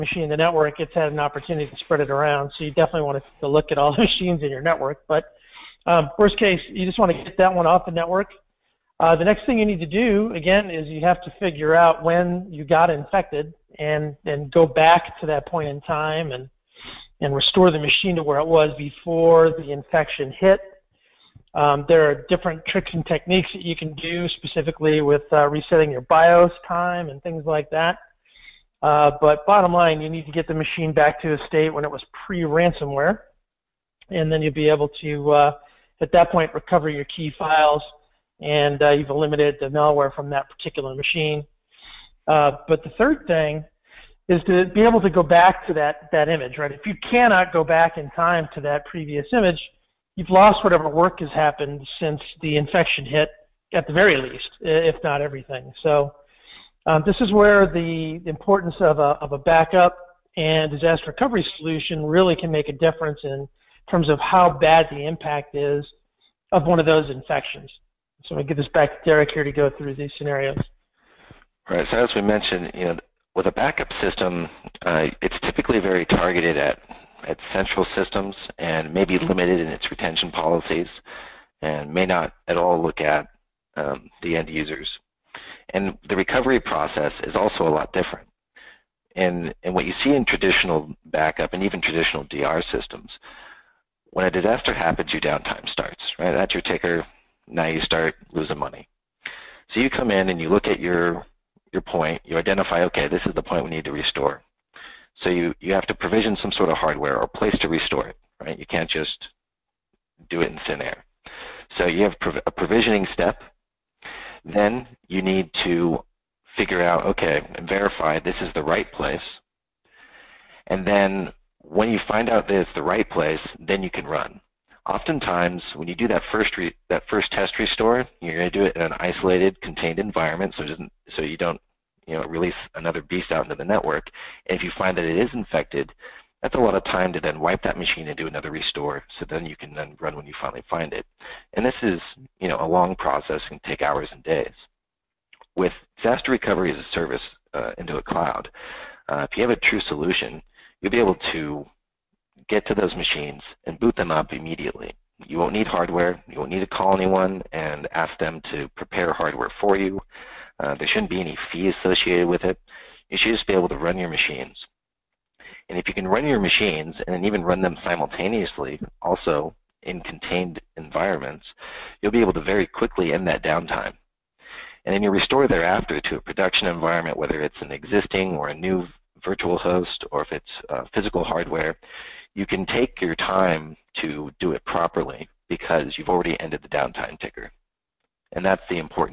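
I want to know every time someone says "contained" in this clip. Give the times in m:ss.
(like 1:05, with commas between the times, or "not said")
2:09, 2:50.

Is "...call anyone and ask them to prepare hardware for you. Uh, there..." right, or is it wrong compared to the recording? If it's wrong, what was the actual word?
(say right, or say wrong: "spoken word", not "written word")
right.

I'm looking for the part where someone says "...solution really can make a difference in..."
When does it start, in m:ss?
1:01.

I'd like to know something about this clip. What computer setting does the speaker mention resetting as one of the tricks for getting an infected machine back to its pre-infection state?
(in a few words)
BIOS time.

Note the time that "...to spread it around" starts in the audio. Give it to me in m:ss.
0:01.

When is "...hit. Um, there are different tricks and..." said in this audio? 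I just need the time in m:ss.
0:20.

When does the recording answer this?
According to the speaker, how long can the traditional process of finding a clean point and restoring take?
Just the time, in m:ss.
2:23.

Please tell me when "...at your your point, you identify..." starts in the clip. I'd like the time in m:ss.
1:40.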